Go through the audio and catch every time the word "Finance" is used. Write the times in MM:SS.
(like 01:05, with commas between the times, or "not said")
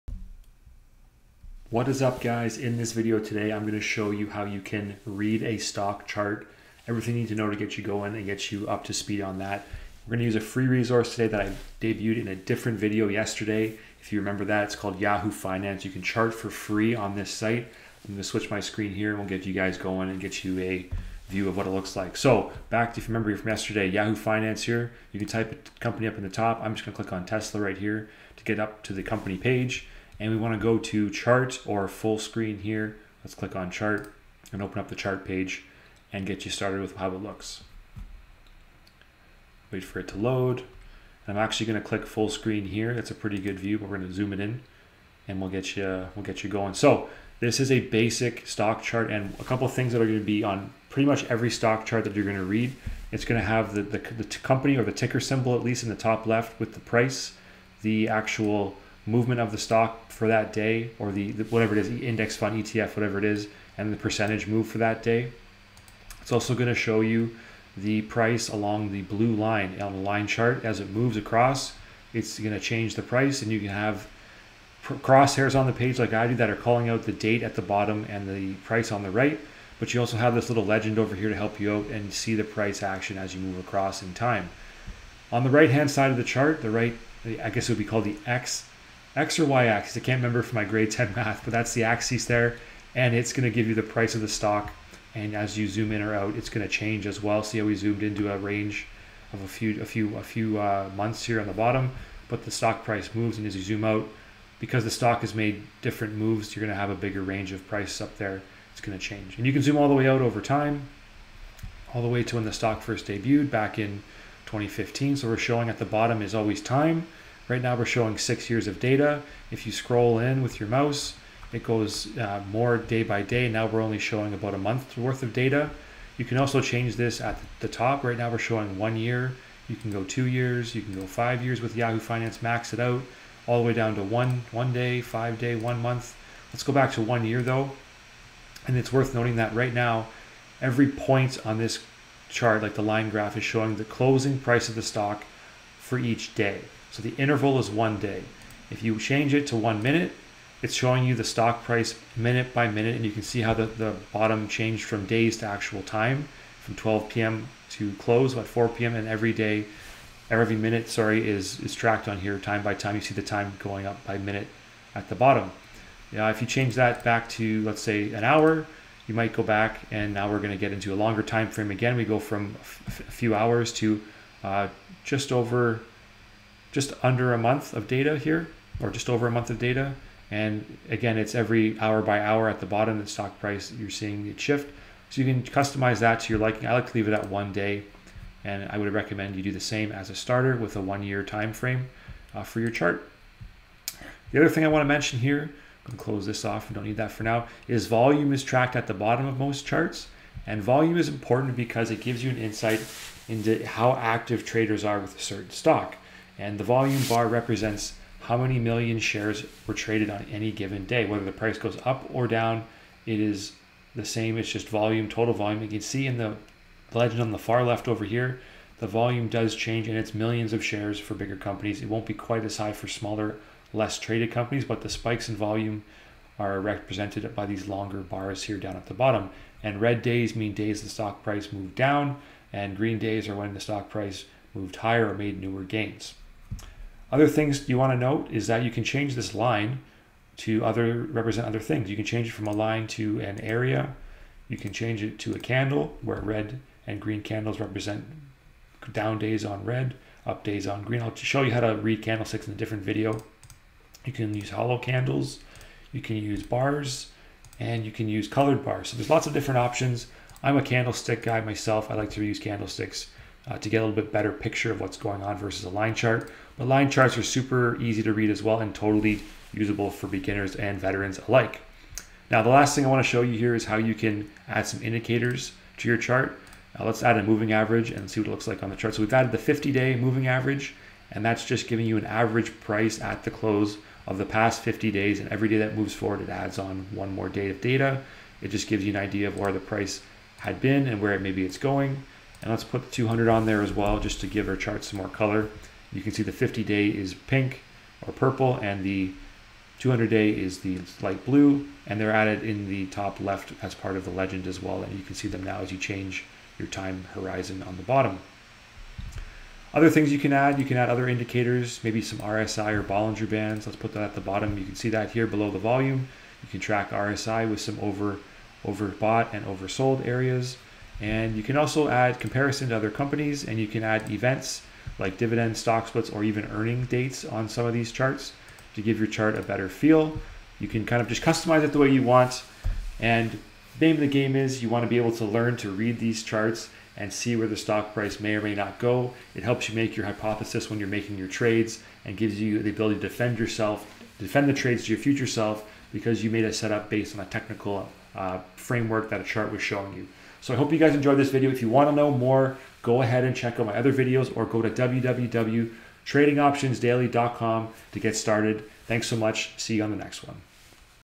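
00:15, 00:24, 02:11.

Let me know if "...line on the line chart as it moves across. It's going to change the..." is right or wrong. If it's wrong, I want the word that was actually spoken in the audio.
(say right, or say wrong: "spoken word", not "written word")
right.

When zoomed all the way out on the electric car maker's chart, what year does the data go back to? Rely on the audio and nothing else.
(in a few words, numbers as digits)
2015.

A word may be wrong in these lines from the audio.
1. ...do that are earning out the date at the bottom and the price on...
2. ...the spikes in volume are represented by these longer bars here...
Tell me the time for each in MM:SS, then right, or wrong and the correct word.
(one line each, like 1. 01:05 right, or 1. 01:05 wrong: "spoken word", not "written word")
1. 01:16 wrong: "calling", not "earning"
2. 03:44 right.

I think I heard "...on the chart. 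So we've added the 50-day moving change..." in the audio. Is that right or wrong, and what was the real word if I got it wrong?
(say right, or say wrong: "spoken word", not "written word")
wrong: "average", not "change".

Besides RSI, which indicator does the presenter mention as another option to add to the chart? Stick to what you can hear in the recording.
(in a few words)
Bollinger Bands.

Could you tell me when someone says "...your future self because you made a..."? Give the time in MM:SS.
05:44.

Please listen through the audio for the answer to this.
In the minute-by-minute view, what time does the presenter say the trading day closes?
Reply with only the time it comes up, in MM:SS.
02:38.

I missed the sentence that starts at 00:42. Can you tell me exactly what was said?
That's a pretty good view, but we're going to zoom it in and we'll get you we'll get you going.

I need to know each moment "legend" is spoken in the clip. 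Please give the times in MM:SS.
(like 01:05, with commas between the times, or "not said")
01:20, 03:36, 05:04.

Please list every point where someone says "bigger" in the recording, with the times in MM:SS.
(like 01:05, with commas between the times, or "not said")
01:46, 03:41.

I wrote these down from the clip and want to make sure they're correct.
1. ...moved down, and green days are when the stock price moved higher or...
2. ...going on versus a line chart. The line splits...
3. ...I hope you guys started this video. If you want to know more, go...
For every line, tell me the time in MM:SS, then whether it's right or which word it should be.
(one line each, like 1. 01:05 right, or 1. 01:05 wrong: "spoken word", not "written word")
1. 03:51 right
2. 04:24 wrong: "charts", not "splits"
3. 05:50 wrong: "enjoyed", not "started".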